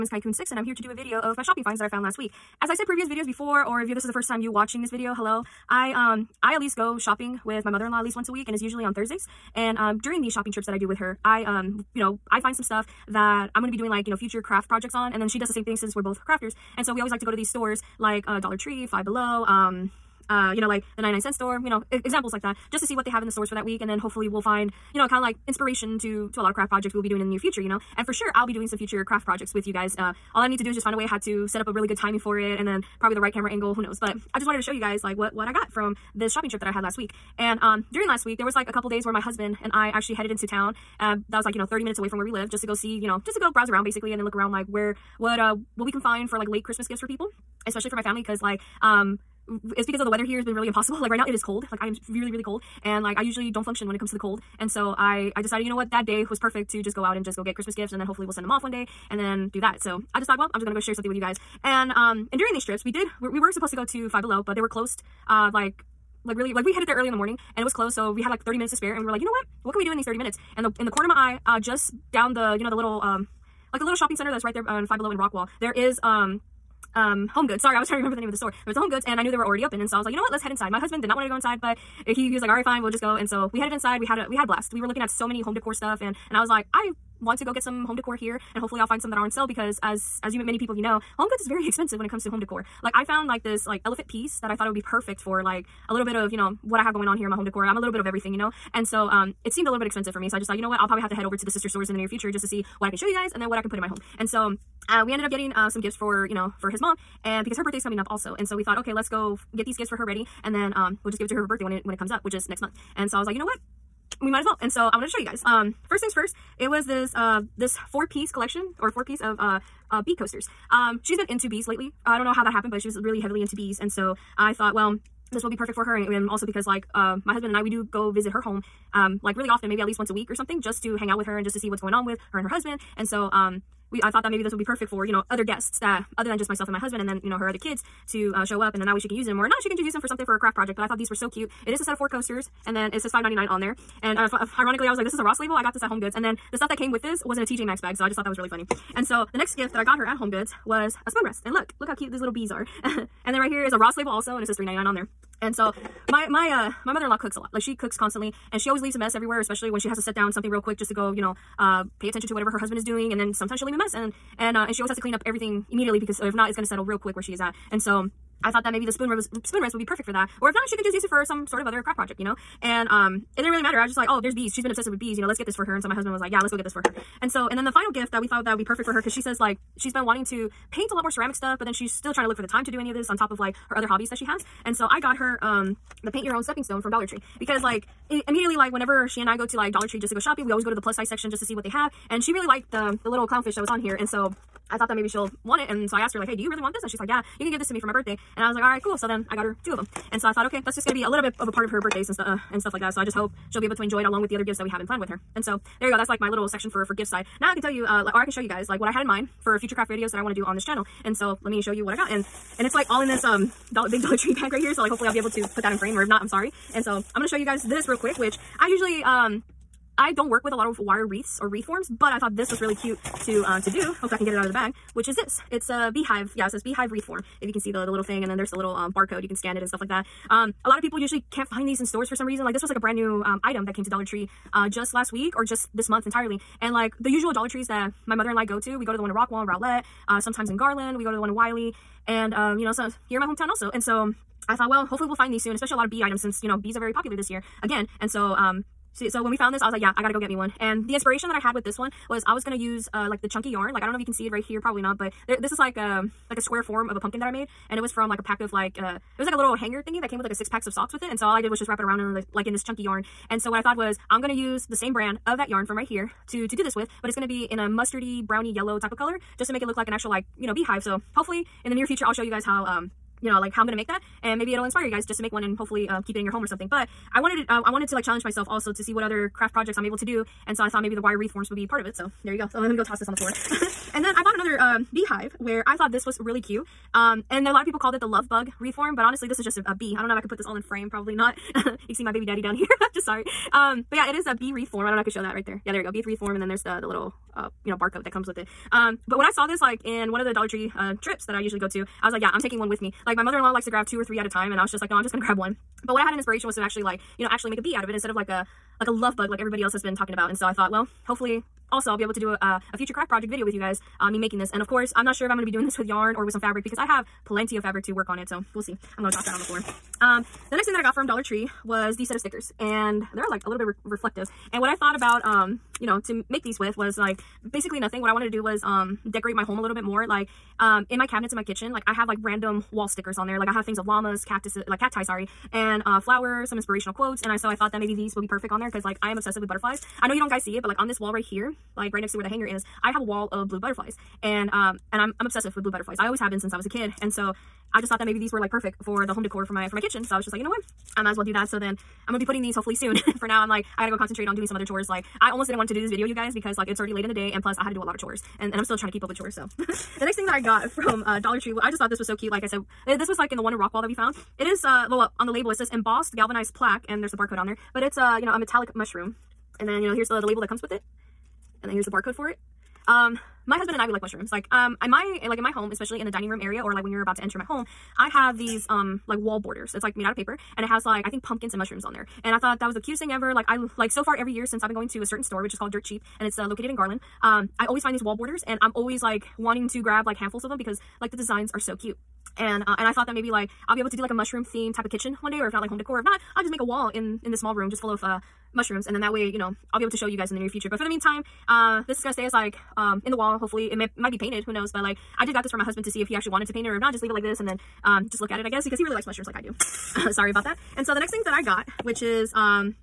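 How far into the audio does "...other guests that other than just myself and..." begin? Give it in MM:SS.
02:15.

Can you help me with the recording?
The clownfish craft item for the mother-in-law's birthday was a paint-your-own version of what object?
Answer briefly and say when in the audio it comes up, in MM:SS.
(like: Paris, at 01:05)
stepping stone, at 03:06.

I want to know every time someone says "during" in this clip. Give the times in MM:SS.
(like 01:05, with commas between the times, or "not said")
00:10, 00:37, 01:02.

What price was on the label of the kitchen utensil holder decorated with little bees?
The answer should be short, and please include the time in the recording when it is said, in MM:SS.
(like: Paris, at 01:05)
3.99, at 02:34.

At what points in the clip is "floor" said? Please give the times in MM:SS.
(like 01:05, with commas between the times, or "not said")
04:43, 05:19.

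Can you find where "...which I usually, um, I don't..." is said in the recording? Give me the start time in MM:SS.
03:38.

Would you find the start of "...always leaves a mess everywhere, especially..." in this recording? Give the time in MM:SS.
02:38.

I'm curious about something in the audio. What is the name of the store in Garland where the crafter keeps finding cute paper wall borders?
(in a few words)
Dirt Cheap.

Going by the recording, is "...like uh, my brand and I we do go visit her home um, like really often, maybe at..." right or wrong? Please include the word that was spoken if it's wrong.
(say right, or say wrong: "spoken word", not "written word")
wrong: "husband", not "brand".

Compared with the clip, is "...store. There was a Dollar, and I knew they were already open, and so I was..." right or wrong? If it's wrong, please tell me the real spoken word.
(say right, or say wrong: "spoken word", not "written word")
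wrong: "HomeGoods", not "Dollar".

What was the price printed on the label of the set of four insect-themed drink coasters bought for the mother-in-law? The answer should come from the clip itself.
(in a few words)
$5.99.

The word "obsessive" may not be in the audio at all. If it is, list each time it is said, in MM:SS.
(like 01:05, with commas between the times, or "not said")
02:54, 05:39, 05:45.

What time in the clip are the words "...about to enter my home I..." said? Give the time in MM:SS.
06:17.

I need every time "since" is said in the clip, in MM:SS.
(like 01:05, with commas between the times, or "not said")
00:15, 04:06, 05:46, 06:24.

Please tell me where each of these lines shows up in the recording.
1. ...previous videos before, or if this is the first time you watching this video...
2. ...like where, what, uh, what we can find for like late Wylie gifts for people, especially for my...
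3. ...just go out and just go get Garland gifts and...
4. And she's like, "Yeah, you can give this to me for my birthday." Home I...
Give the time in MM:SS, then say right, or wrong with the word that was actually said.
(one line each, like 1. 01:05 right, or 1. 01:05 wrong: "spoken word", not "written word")
1. 00:02 right
2. 00:44 wrong: "Christmas", not "Wylie"
3. 00:56 wrong: "Christmas", not "Garland"
4. 03:16 wrong: "And", not "Home".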